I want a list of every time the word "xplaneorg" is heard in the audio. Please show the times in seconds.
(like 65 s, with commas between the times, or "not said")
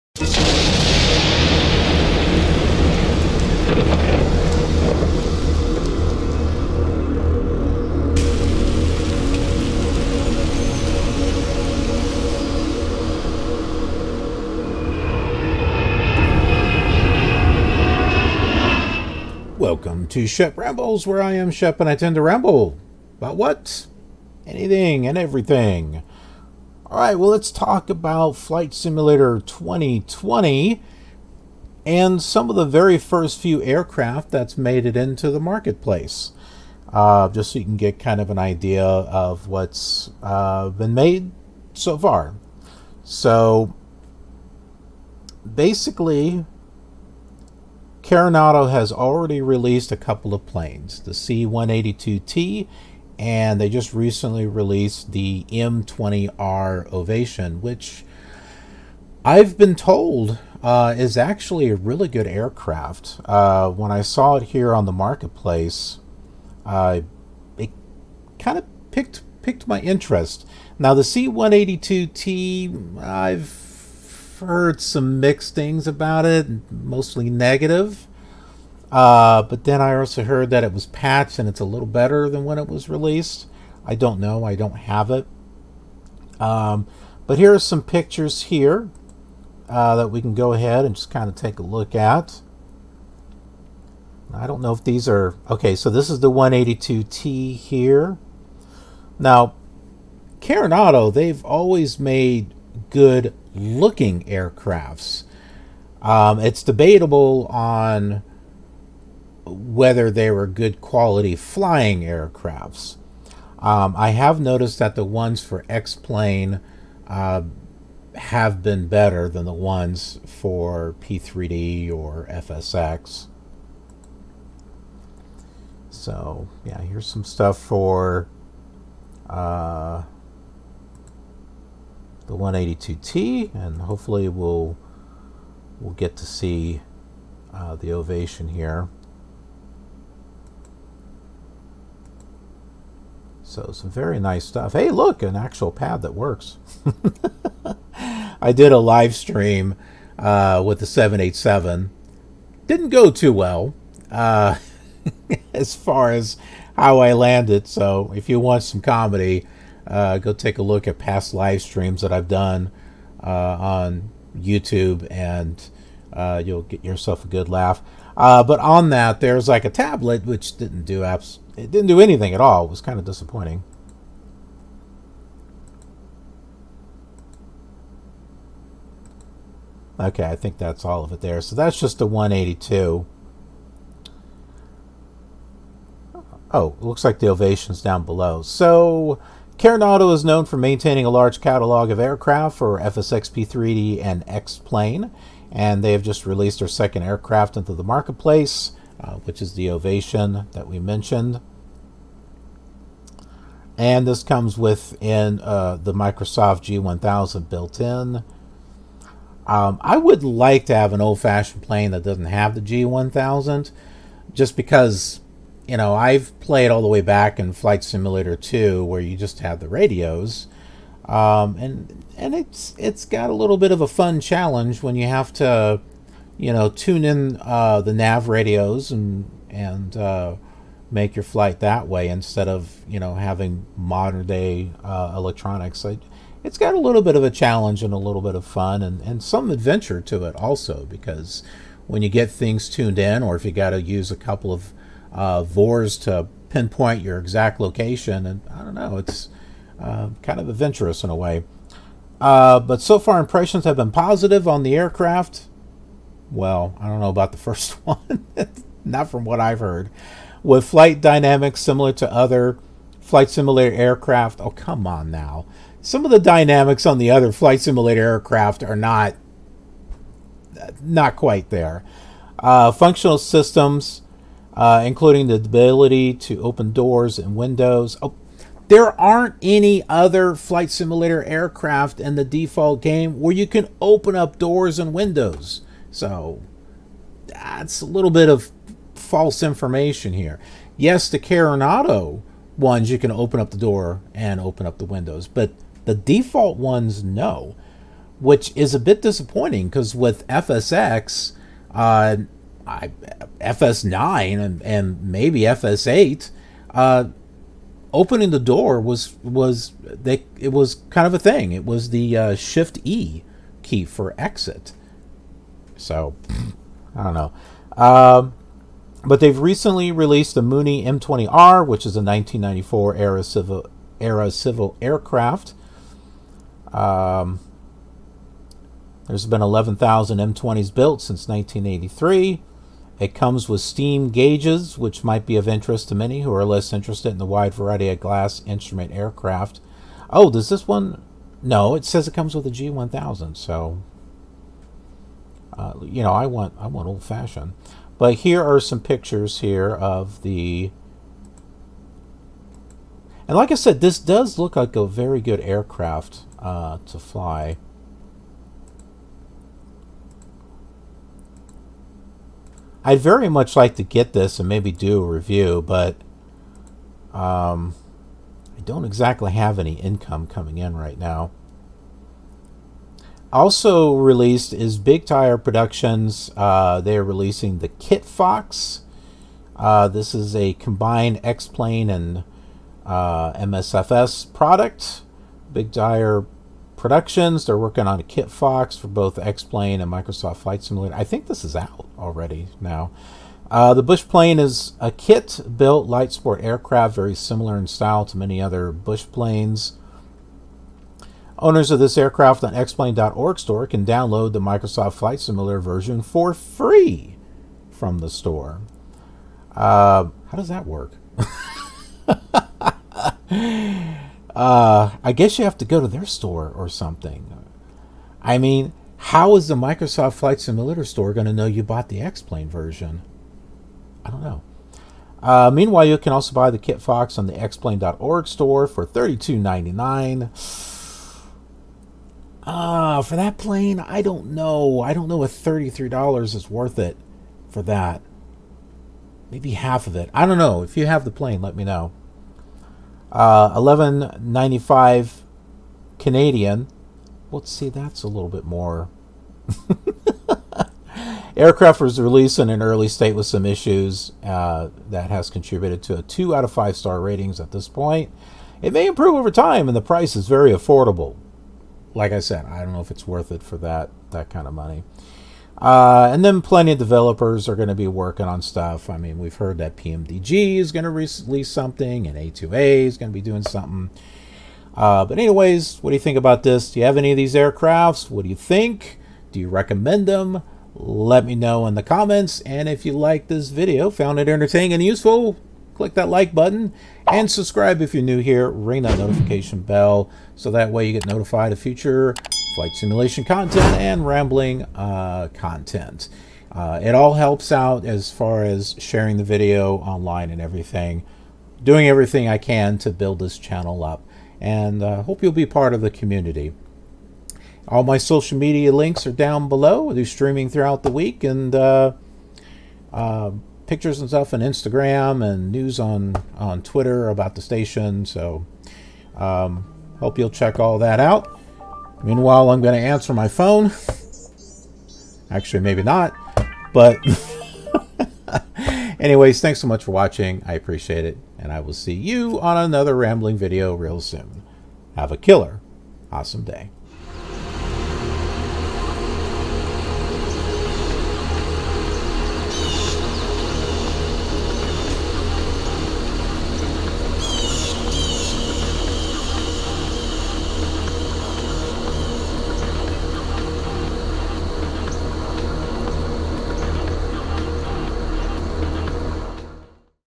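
402 s, 427 s.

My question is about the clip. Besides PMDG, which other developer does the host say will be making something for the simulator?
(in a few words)
A2A.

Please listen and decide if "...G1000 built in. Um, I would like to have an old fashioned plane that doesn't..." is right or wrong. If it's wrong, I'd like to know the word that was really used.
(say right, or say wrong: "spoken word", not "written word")
right.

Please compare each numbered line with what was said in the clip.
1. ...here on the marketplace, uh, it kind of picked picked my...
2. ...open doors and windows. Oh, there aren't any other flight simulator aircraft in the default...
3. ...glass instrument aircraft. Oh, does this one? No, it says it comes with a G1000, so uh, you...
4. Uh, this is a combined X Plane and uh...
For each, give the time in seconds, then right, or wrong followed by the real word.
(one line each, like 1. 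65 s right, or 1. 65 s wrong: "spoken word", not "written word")
1. 64 s right
2. 276 s right
3. 337 s right
4. 379 s right.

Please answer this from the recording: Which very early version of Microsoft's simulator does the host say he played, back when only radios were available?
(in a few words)
Flight Simulator 2.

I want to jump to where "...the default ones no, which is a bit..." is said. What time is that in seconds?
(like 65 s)
295 s.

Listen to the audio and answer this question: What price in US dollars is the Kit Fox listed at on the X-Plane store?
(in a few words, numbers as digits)
$32.99.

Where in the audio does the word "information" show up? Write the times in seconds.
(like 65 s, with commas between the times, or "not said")
289 s.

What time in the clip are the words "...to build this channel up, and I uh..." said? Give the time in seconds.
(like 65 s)
502 s.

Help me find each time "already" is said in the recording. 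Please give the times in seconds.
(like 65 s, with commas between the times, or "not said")
48 s, 391 s.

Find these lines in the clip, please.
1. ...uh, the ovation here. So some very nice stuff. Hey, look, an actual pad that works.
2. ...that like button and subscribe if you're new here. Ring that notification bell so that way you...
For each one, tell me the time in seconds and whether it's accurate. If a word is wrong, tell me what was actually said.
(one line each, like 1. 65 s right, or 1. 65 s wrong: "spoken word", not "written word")
1. 137 s right
2. 485 s right.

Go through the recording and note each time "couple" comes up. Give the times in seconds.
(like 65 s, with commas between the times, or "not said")
49 s, 244 s.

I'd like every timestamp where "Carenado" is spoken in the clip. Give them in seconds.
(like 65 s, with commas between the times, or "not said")
48 s, 100 s, 291 s.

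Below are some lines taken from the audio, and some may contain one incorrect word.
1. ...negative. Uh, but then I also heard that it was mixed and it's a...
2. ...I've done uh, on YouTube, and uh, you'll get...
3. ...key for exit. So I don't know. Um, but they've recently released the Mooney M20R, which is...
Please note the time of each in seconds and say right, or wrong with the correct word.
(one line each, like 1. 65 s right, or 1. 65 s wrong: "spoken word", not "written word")
1. 77 s wrong: "patched", not "mixed"
2. 162 s right
3. 313 s right.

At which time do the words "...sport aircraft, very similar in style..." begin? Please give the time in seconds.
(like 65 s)
396 s.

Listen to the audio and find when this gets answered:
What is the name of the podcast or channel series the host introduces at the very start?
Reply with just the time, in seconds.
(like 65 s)
20 s.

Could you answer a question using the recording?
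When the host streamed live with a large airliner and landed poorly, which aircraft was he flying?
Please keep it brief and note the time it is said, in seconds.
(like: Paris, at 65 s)
787, at 150 s.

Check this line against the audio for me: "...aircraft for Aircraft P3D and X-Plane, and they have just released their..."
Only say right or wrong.
wrong.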